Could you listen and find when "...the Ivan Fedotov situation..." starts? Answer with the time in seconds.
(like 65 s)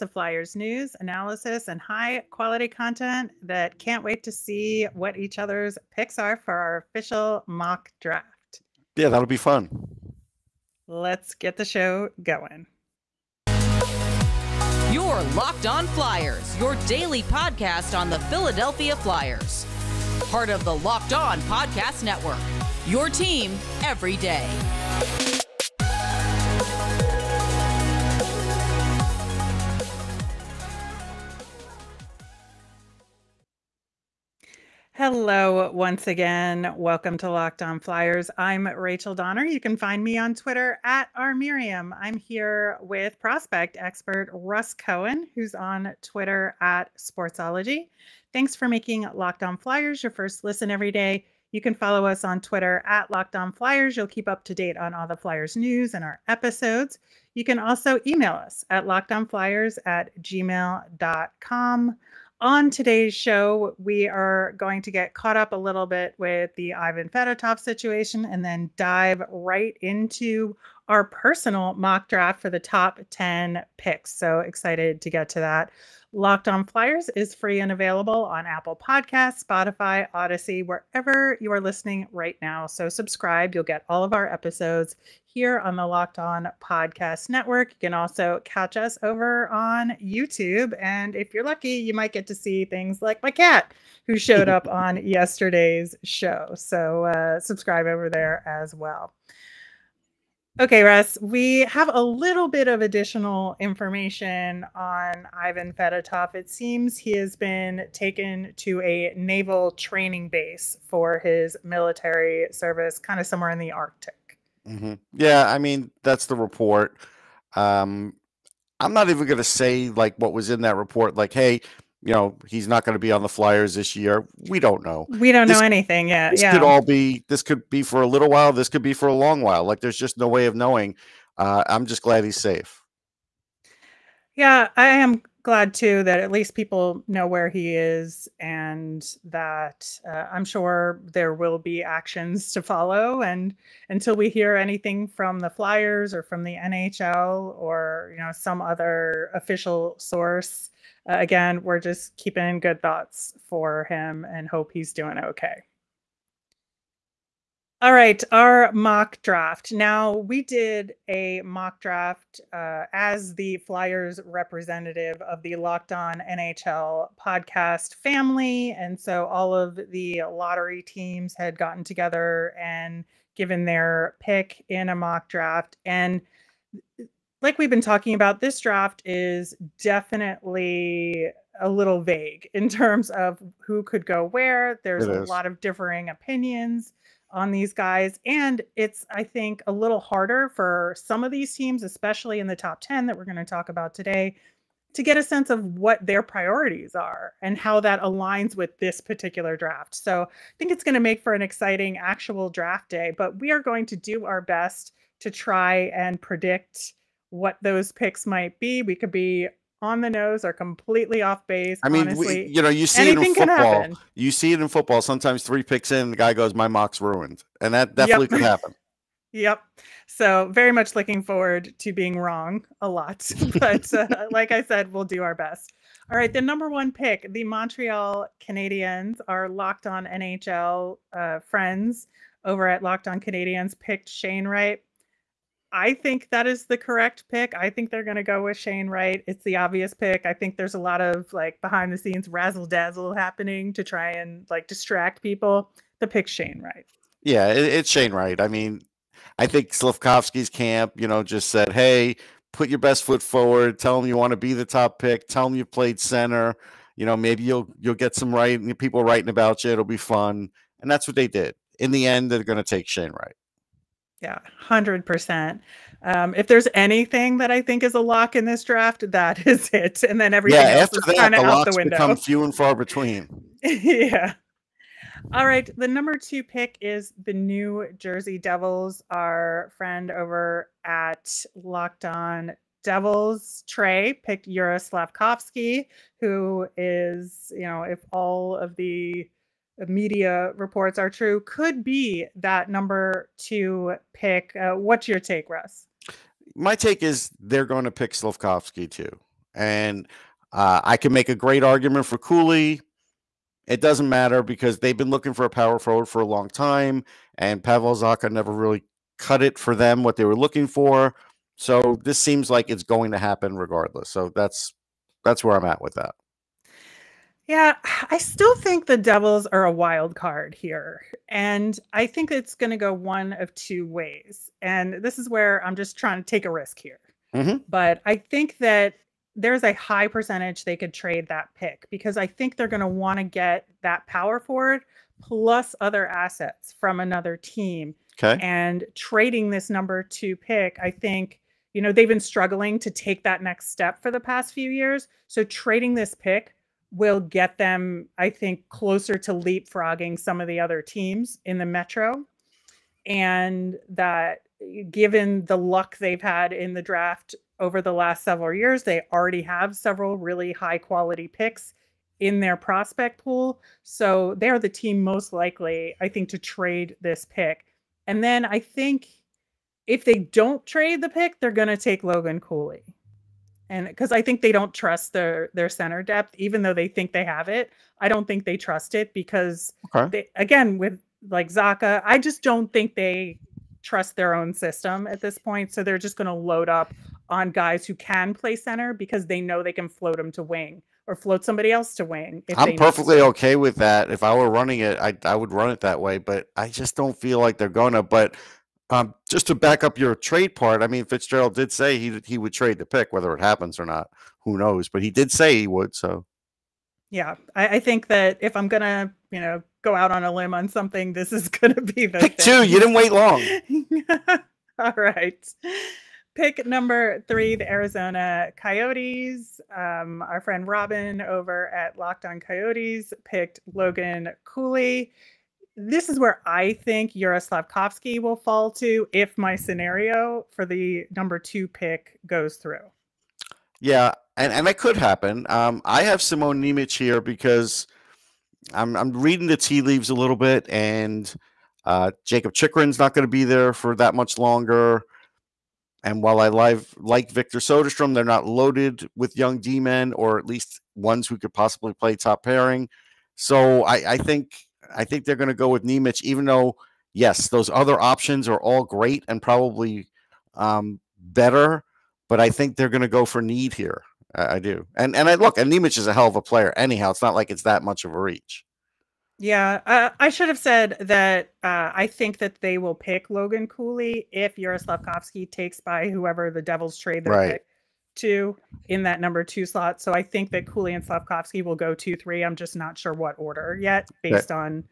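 66 s.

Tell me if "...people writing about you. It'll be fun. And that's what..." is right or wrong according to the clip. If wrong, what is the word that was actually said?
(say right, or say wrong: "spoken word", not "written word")
right.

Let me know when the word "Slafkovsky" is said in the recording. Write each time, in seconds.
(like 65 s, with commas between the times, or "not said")
249 s, 284 s, 298 s, 427 s, 481 s.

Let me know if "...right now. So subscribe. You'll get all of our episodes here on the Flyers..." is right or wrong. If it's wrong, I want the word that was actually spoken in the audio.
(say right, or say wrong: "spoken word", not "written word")
wrong: "Locked", not "Flyers".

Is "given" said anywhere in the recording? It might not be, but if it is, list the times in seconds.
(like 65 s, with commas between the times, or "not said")
173 s, 354 s.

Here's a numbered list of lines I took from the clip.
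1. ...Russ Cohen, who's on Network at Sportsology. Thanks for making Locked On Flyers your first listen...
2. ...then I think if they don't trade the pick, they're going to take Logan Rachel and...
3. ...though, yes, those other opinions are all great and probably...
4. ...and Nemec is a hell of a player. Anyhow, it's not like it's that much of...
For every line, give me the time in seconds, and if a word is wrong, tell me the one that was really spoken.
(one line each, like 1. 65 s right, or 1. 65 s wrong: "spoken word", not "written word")
1. 44 s wrong: "Twitter", not "Network"
2. 368 s wrong: "Cooley", not "Rachel"
3. 456 s wrong: "options", not "opinions"
4. 465 s right.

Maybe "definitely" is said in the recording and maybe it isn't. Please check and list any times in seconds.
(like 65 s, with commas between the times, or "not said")
179 s, 217 s.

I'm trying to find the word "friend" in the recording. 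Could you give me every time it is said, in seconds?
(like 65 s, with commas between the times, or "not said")
231 s, 279 s, 420 s.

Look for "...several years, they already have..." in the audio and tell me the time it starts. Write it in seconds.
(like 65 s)
358 s.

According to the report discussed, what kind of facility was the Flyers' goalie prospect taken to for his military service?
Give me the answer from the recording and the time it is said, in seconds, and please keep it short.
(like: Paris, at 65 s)
Naval training base, at 109 s.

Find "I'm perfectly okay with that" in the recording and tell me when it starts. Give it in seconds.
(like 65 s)
392 s.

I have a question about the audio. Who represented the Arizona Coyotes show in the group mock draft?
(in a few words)
Robin.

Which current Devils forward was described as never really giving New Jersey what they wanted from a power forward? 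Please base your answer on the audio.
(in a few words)
Pavel Zacha.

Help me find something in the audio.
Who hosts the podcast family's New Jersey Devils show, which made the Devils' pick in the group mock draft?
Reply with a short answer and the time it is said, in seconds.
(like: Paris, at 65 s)
Trey, at 283 s.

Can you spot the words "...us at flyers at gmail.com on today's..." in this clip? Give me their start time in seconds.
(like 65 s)
58 s.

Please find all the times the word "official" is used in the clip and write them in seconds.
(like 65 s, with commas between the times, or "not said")
6 s, 149 s.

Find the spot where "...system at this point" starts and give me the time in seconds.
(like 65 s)
384 s.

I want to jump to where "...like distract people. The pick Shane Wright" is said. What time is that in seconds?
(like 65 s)
244 s.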